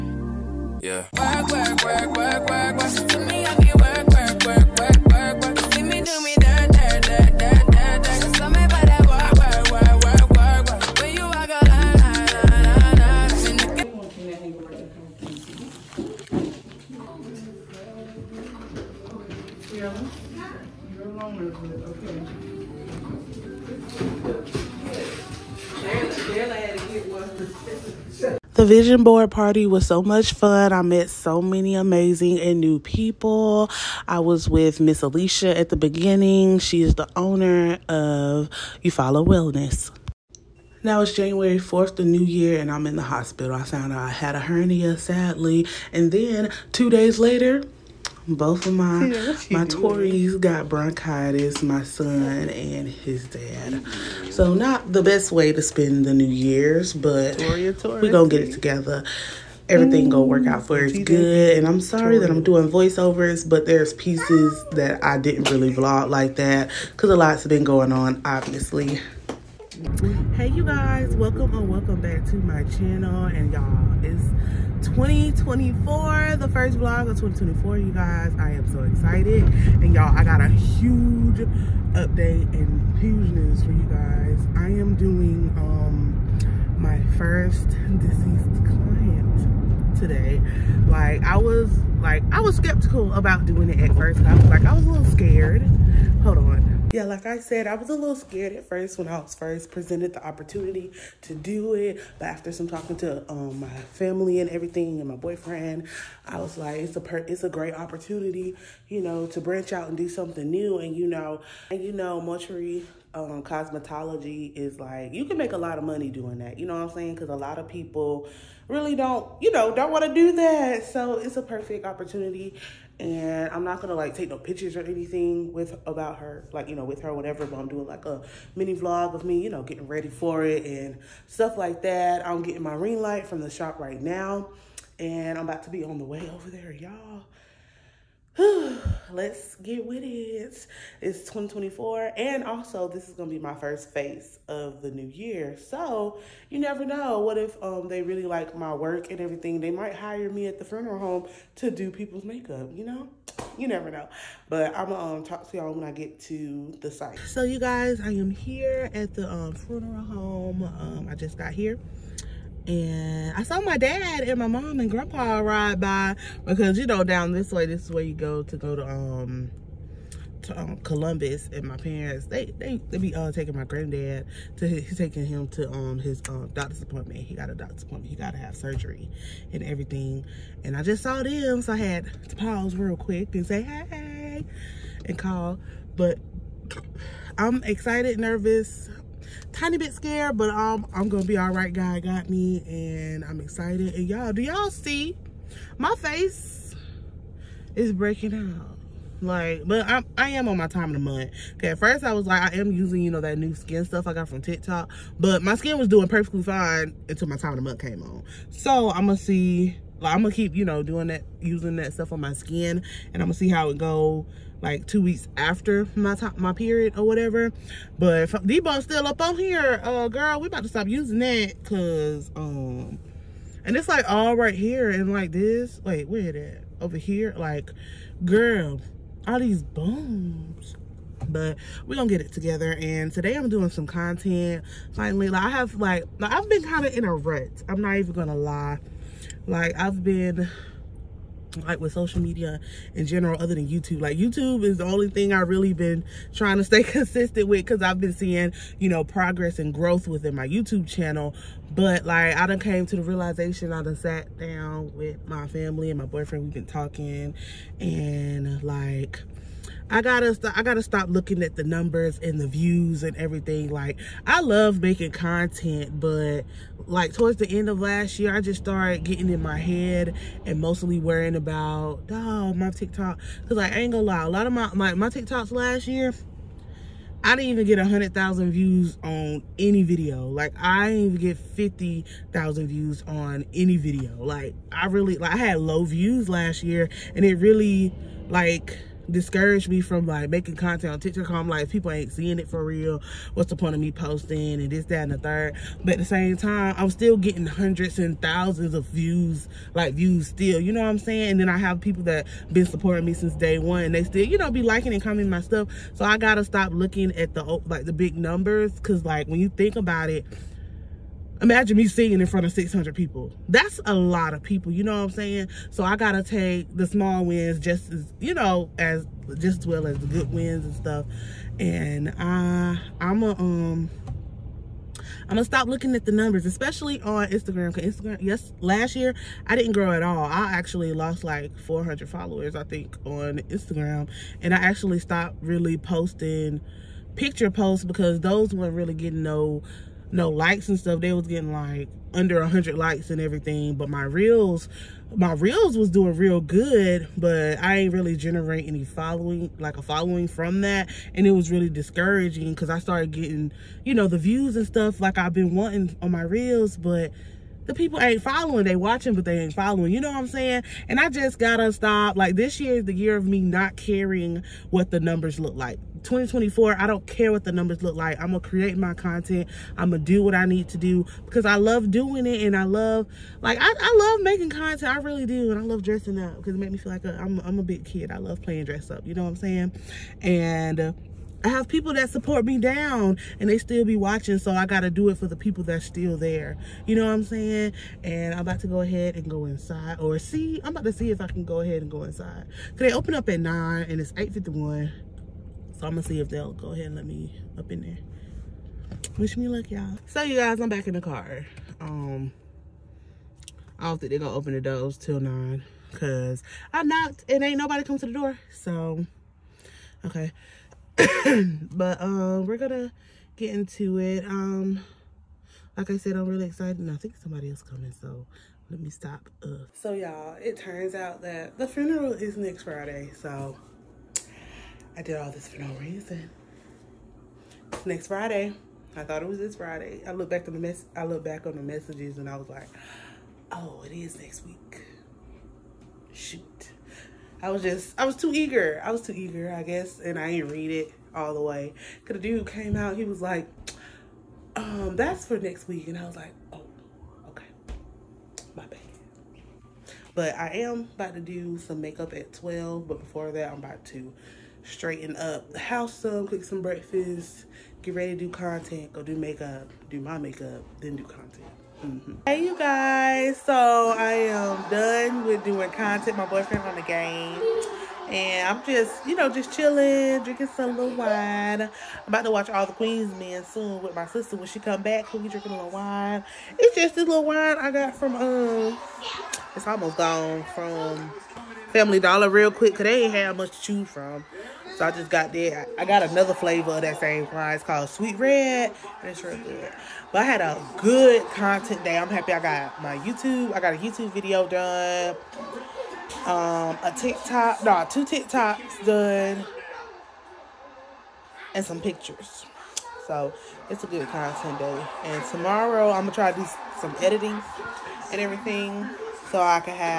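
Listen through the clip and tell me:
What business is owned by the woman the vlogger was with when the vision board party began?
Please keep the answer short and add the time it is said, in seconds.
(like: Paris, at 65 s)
You Follow Wellness, at 38 s.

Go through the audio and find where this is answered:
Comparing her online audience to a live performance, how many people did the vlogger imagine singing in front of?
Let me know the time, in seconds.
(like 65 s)
312 s.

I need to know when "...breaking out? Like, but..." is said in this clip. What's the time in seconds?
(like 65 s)
197 s.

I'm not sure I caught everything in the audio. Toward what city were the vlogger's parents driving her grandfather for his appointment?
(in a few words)
Columbus.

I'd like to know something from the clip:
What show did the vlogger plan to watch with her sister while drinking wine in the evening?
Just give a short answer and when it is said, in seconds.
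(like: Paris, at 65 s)
All the Queen's Men, at 472 s.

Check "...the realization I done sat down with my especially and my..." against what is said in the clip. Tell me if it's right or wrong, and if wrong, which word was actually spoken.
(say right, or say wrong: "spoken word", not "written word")
wrong: "family", not "especially".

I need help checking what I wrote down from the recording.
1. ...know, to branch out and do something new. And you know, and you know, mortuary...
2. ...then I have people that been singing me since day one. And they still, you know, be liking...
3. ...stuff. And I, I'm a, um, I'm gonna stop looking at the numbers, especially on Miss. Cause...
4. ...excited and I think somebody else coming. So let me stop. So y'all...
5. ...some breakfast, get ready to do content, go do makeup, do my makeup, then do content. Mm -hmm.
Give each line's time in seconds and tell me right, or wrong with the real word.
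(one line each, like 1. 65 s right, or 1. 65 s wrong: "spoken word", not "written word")
1. 109 s right
2. 301 s wrong: "supporting", not "singing"
3. 320 s wrong: "Instagram", not "Miss"
4. 416 s right
5. 456 s right.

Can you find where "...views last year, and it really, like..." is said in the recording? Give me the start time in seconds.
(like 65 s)
285 s.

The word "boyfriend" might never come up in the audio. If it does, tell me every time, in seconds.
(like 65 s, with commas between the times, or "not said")
105 s, 256 s, 466 s.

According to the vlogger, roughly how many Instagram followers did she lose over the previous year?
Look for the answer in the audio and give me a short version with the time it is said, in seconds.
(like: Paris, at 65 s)
400, at 331 s.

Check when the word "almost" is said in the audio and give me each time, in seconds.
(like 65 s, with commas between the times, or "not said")
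479 s.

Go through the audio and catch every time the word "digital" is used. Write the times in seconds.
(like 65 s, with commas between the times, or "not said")
not said.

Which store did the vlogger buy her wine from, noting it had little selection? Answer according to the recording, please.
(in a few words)
Family Dollar.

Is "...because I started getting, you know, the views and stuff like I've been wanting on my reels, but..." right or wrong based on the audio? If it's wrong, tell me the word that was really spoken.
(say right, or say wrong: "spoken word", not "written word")
right.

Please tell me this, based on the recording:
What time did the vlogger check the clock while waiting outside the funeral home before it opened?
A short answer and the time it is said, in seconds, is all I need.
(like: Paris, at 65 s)
8:51, at 394 s.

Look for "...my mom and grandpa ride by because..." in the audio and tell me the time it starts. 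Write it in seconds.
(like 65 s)
164 s.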